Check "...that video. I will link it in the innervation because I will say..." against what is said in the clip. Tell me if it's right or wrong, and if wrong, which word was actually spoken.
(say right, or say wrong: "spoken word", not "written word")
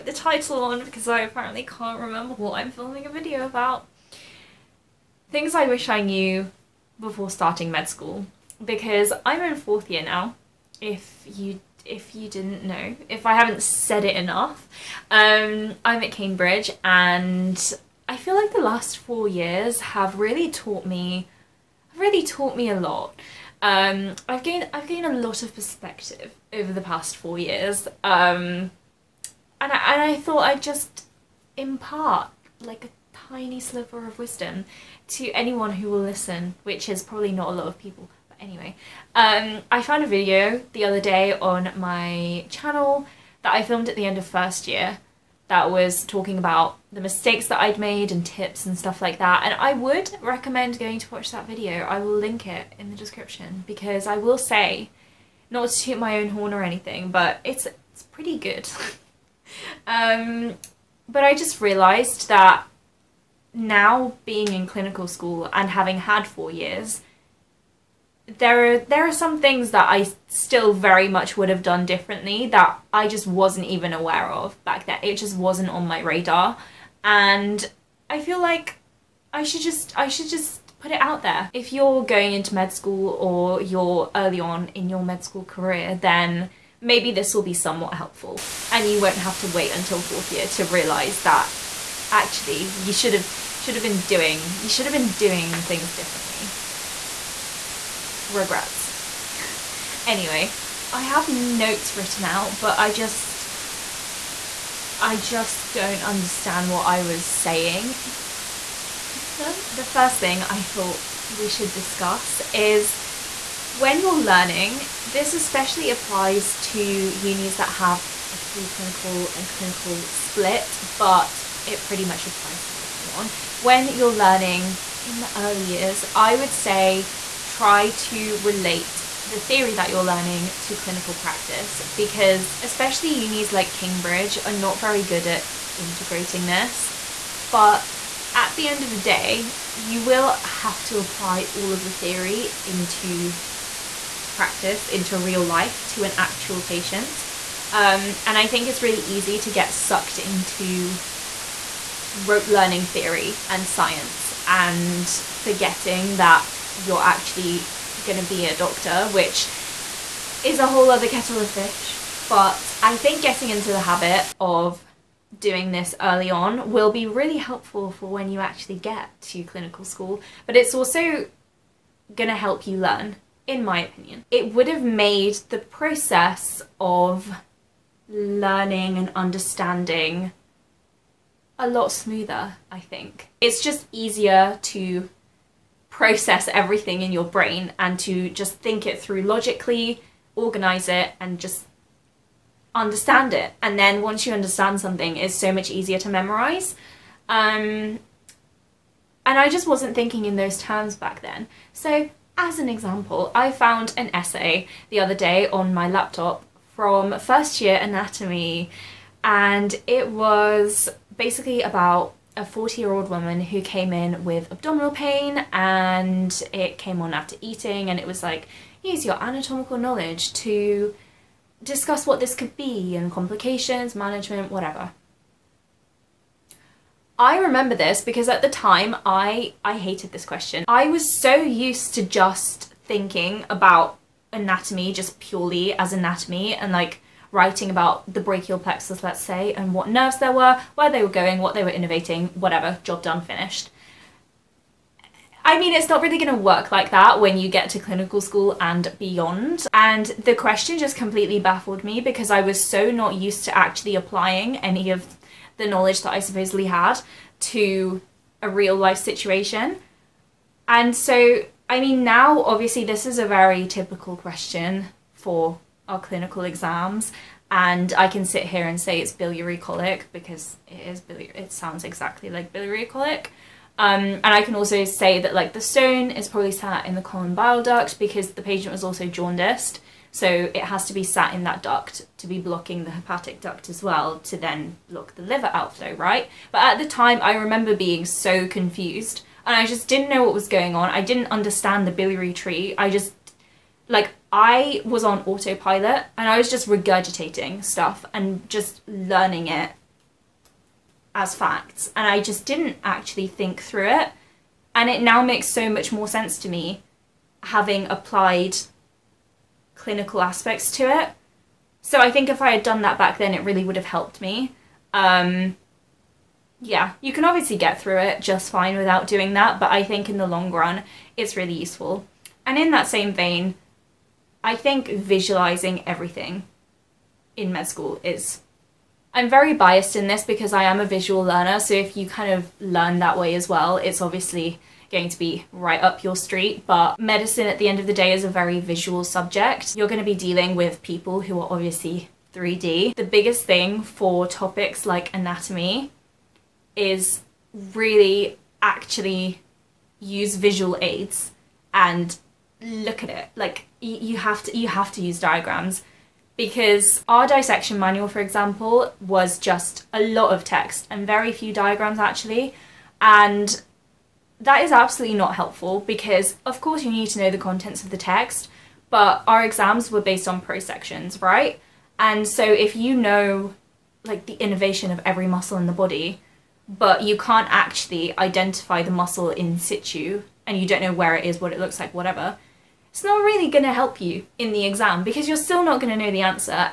wrong: "description", not "innervation".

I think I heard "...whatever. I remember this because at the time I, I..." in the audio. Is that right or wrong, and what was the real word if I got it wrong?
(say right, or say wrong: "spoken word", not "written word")
right.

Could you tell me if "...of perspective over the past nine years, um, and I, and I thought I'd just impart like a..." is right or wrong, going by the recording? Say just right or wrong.
wrong.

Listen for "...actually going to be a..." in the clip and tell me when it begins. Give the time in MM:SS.
02:37.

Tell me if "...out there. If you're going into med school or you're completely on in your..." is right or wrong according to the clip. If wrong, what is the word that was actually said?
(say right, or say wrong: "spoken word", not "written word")
wrong: "early", not "completely".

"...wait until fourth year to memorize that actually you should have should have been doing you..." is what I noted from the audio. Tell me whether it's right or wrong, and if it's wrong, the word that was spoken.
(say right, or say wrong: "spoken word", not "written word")
wrong: "realize", not "memorize".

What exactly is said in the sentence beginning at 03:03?
It's just easier to process everything in your brain and to just think it through logically, organize it, and just understand it.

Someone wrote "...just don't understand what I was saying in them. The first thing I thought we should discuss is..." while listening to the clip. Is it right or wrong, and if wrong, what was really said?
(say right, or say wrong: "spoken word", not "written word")
right.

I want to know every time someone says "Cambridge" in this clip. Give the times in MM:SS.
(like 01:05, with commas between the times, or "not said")
00:16, 02:13.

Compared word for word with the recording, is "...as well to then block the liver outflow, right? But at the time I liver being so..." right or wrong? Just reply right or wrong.
wrong.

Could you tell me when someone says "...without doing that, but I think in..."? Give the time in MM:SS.
05:18.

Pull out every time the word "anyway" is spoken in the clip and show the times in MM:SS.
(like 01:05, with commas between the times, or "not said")
00:38, 01:40.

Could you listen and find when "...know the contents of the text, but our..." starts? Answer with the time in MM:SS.
06:07.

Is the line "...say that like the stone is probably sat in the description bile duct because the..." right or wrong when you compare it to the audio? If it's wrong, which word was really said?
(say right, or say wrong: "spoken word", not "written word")
wrong: "common", not "description".